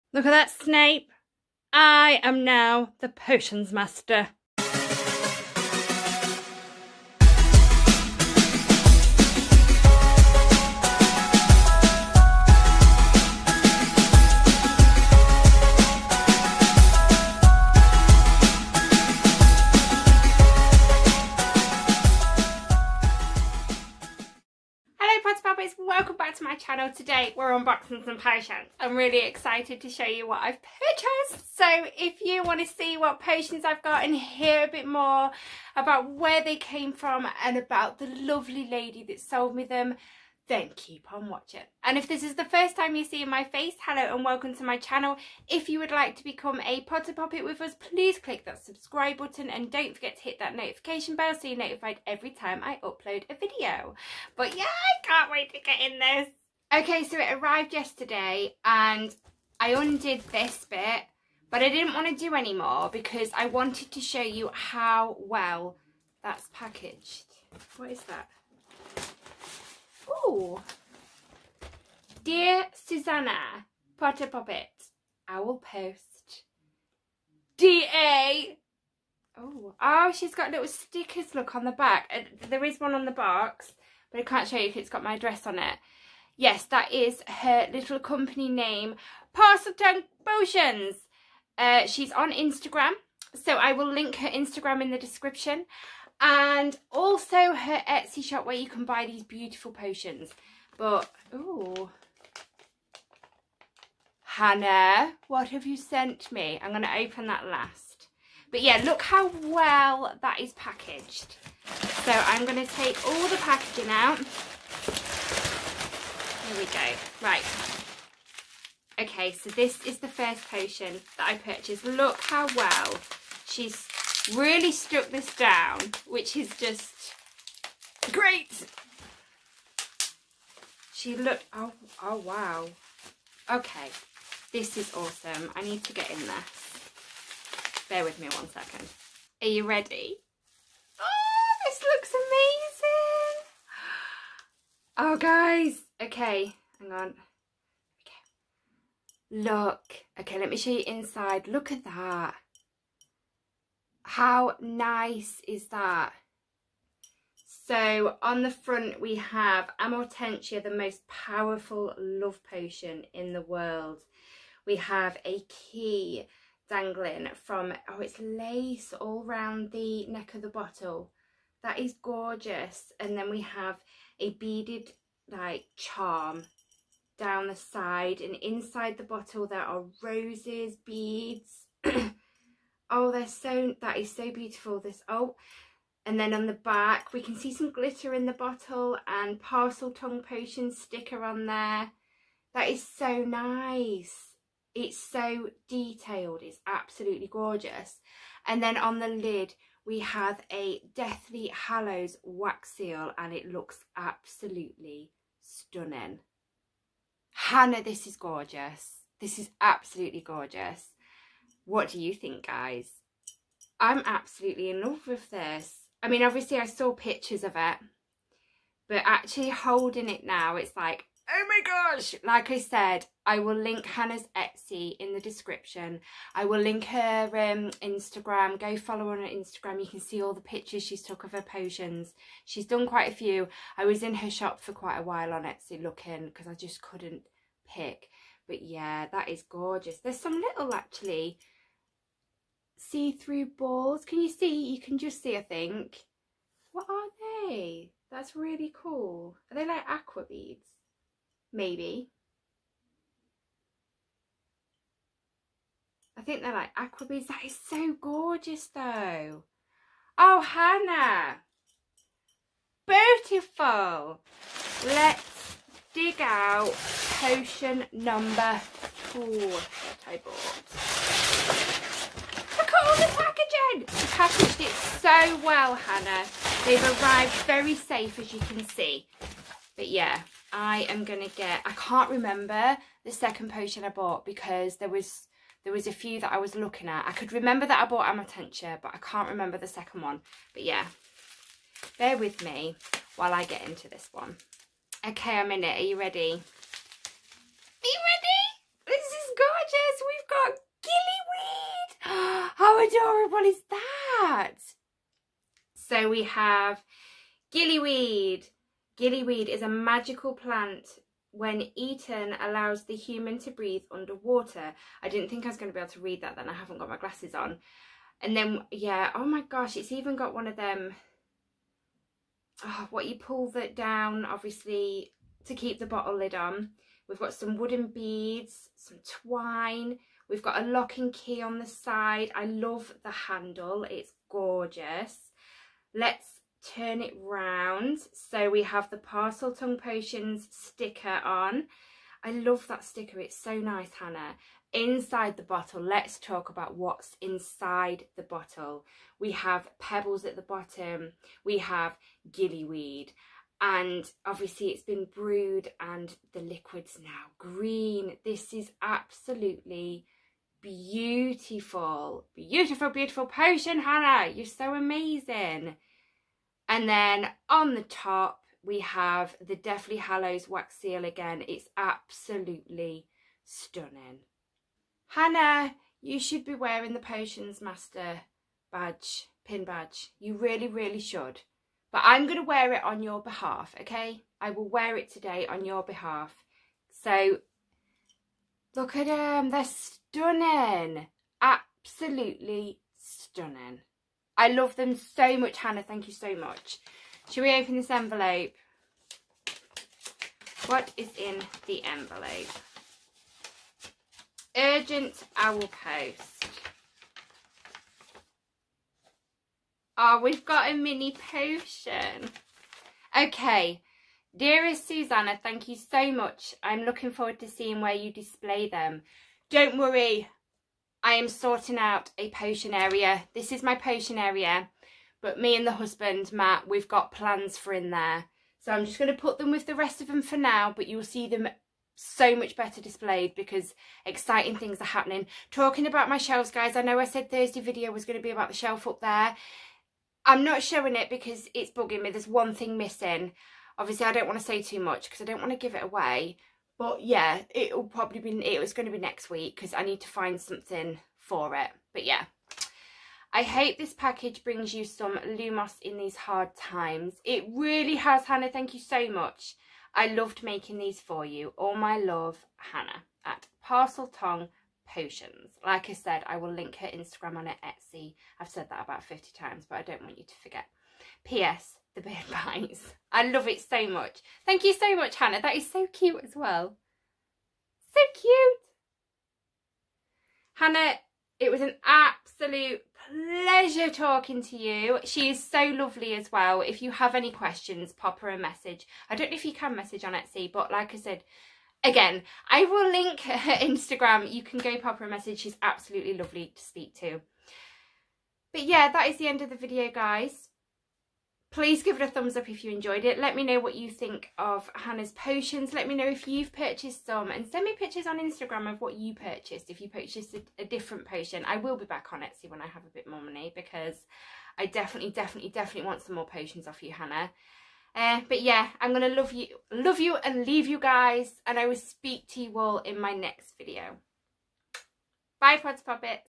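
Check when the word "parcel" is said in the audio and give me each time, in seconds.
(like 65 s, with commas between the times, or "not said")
89 s, 189 s.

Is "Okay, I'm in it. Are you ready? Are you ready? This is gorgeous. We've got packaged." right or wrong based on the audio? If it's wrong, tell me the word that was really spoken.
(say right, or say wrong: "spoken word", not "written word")
wrong: "gillyweed", not "packaged".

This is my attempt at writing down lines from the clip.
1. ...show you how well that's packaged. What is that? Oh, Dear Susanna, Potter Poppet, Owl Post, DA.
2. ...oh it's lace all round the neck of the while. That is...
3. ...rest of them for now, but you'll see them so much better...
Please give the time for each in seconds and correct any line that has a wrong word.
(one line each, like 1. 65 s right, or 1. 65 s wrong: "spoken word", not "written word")
1. 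63 s right
2. 167 s wrong: "bottle", not "while"
3. 429 s right.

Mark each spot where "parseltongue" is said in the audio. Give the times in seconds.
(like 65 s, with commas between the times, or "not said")
338 s, 463 s.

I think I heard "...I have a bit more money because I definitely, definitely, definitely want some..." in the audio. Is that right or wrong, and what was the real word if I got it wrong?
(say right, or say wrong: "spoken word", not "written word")
right.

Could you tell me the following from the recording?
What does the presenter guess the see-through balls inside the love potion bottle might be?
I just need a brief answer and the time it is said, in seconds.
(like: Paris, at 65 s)
Aqua beads, at 249 s.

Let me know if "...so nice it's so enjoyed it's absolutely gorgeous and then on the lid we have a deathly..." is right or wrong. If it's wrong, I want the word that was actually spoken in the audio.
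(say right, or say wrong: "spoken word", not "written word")
wrong: "detailed", not "enjoyed".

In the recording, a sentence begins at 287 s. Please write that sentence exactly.
I could remember that I bought Amortentia, but I can't remember the second one.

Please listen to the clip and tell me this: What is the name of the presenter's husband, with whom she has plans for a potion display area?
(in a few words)
Matt.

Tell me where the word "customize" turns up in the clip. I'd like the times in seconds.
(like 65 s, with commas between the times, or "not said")
not said.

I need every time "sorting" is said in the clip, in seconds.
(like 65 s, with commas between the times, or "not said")
421 s.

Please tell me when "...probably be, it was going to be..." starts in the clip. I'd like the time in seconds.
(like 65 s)
447 s.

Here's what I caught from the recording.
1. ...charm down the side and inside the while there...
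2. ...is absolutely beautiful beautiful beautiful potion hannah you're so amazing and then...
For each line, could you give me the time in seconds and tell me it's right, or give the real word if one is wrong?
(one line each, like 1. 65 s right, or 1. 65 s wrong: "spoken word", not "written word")
1. 175 s wrong: "bottle", not "while"
2. 358 s right.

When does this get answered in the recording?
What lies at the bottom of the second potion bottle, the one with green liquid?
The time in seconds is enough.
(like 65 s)
349 s.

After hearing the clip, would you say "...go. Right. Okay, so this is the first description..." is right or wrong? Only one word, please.
wrong.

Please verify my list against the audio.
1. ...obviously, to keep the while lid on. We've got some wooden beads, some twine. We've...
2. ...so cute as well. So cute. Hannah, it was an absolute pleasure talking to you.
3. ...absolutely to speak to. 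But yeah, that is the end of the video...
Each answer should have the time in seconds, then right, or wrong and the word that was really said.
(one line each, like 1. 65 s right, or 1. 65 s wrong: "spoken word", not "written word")
1. 324 s wrong: "bottle", not "while"
2. 475 s right
3. 496 s wrong: "lovely", not "absolutely".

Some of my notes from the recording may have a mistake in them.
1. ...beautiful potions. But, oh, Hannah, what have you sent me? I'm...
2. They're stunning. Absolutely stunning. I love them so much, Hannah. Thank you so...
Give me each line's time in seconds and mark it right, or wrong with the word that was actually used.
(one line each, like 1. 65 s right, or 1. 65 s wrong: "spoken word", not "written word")
1. 99 s right
2. 389 s right.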